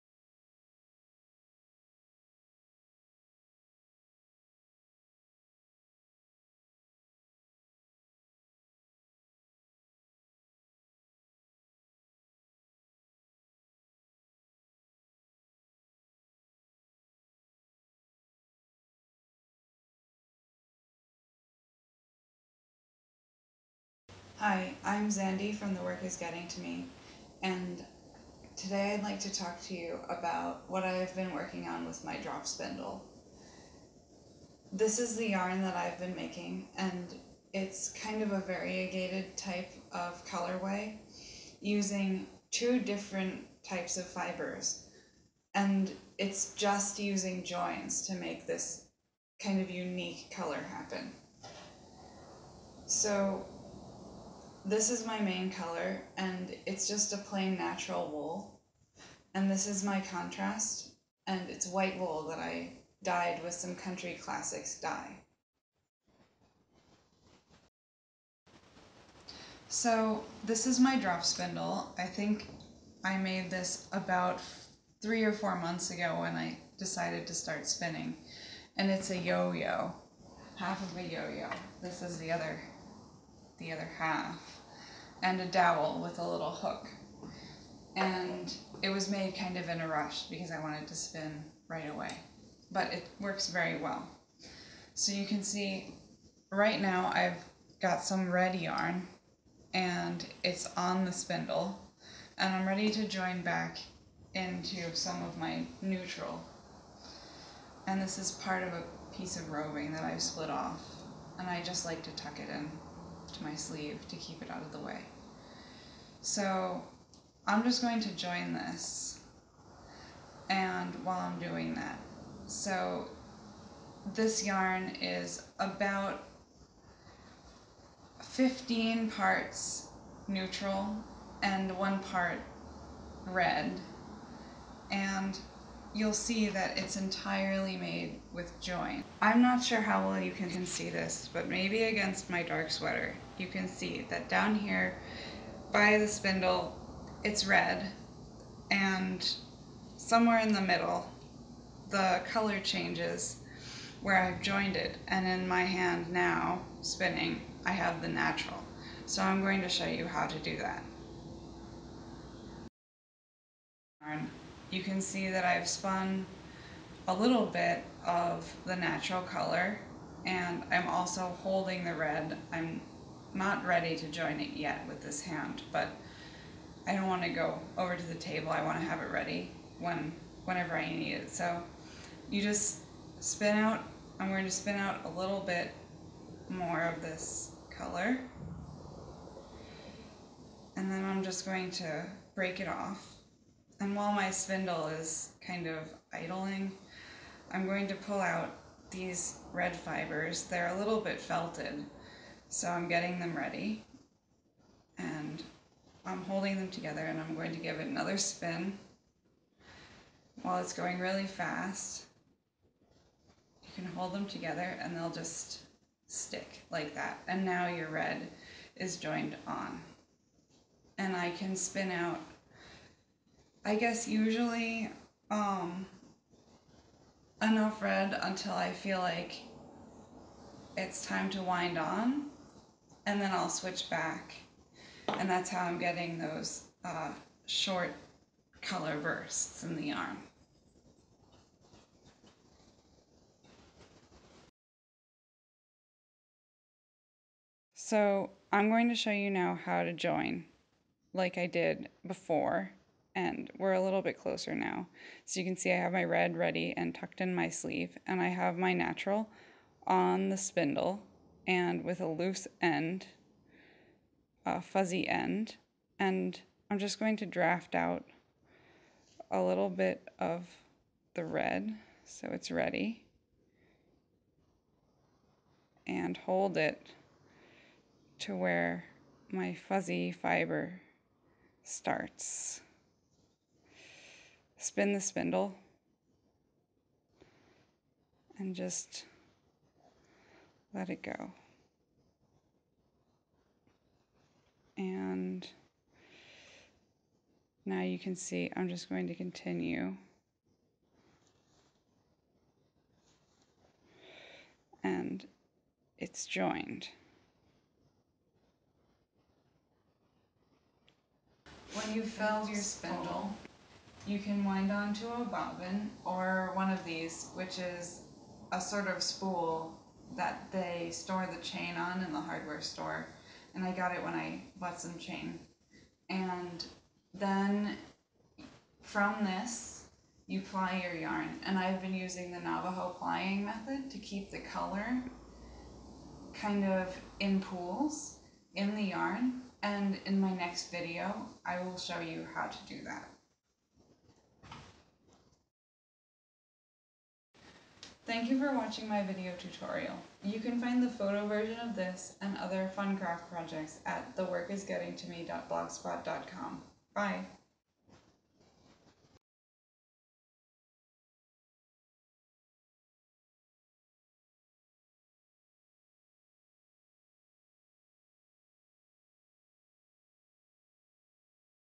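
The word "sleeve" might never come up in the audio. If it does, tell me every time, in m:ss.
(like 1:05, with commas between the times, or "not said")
1:53, 4:17.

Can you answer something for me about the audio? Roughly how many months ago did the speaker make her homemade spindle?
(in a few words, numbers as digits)
3 or 4 months.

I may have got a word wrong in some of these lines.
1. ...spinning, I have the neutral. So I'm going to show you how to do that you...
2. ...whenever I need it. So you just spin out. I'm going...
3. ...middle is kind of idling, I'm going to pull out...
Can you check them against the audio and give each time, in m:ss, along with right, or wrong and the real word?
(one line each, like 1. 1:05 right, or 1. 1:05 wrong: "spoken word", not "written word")
1. 2:36 wrong: "natural", not "neutral"
2. 3:00 right
3. 3:14 wrong: "spindle", not "middle".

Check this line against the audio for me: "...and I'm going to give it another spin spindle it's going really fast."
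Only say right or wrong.
wrong.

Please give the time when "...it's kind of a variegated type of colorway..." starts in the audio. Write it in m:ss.
0:37.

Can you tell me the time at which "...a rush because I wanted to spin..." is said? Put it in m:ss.
1:29.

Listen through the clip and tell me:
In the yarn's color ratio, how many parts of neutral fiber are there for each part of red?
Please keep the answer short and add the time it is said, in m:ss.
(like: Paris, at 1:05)
15, at 2:08.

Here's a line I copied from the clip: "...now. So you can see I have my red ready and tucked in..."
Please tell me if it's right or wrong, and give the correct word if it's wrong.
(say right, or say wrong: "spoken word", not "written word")
right.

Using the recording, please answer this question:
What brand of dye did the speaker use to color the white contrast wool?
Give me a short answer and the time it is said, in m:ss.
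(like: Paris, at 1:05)
Country Classics, at 1:03.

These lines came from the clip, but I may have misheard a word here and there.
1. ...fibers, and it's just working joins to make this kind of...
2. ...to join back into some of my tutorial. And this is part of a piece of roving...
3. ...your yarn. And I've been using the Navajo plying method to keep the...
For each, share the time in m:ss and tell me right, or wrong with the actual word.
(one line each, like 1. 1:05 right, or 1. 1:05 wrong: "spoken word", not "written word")
1. 0:44 wrong: "using", not "working"
2. 1:42 wrong: "neutral", not "tutorial"
3. 5:30 right.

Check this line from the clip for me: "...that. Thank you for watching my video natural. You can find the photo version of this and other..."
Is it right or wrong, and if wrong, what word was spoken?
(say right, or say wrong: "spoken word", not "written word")
wrong: "tutorial", not "natural".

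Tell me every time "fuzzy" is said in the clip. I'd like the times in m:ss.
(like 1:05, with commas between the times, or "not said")
4:24, 4:39.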